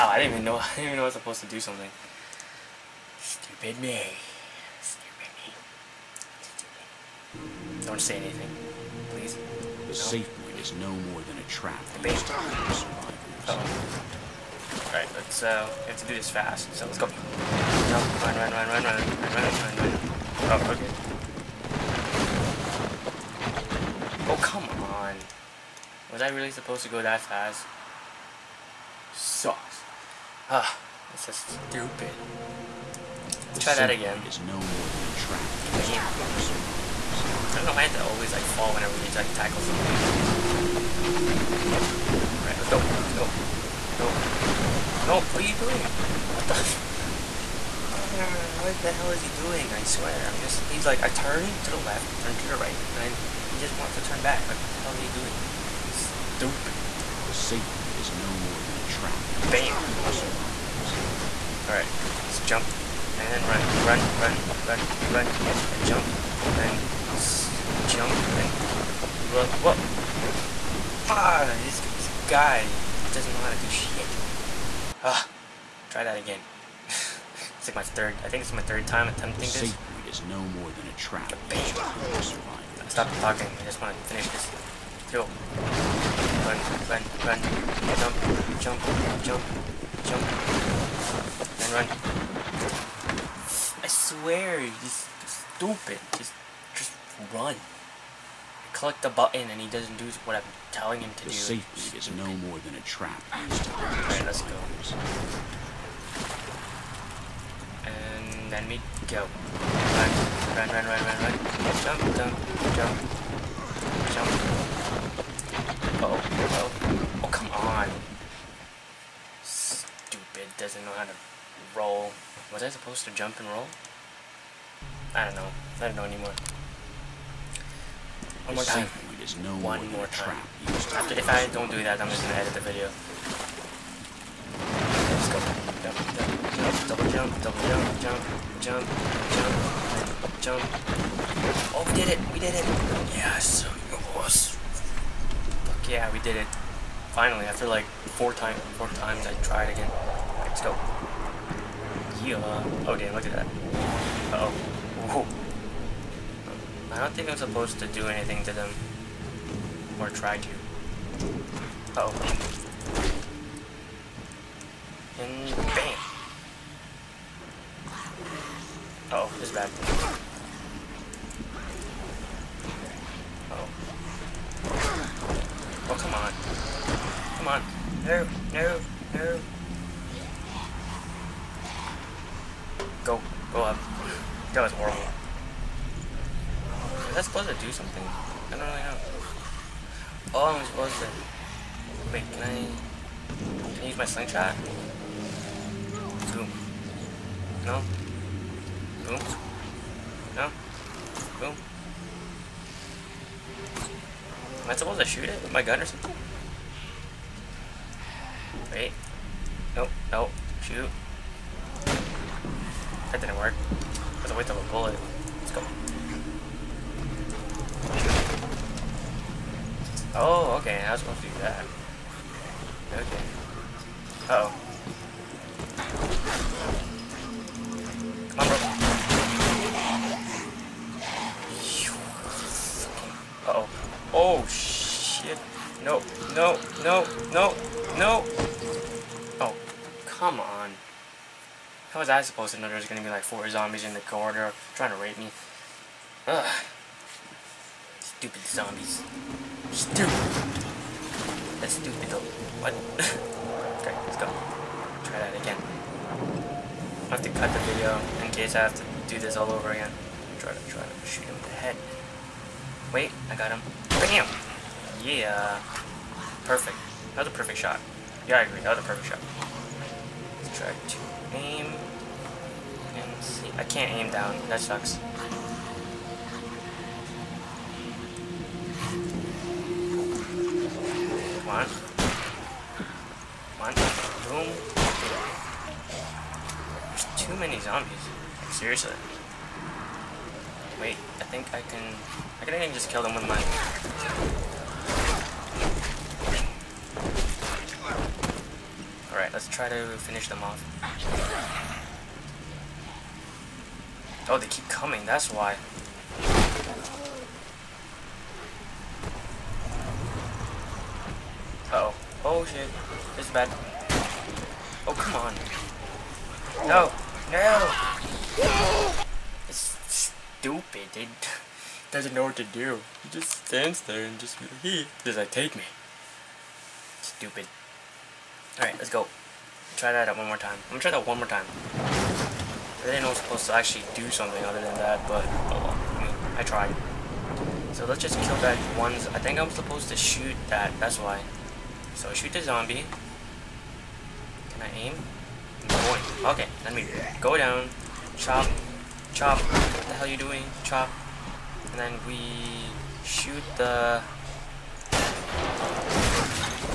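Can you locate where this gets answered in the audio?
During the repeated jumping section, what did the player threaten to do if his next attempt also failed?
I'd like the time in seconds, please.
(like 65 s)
132 s.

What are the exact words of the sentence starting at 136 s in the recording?
Double jump, double jump, jump, jump, jump, jump.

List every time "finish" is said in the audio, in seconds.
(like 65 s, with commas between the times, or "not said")
84 s, 299 s.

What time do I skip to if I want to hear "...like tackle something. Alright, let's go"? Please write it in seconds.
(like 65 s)
39 s.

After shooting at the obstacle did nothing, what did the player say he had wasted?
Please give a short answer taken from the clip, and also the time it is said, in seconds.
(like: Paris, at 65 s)
a bullet, at 214 s.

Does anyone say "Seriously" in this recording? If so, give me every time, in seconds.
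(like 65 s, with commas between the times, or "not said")
288 s.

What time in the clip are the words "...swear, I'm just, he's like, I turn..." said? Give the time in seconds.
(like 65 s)
49 s.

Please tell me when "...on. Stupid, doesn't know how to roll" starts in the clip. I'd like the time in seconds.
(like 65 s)
117 s.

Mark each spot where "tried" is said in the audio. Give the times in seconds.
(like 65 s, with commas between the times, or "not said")
149 s, 336 s.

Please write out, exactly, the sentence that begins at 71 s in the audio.
Ah, this, this guy doesn't know how to do shit.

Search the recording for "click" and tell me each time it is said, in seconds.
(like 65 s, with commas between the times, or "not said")
98 s.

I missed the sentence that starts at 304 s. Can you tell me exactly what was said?
Oh, they keep coming, that's why.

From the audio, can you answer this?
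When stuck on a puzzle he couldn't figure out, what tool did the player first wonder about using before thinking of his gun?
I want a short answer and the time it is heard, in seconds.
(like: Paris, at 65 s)
slingshot, at 194 s.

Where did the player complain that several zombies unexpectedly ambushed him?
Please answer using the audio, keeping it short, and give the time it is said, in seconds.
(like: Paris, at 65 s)
the corridor, at 244 s.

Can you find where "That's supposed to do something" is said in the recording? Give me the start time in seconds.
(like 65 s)
187 s.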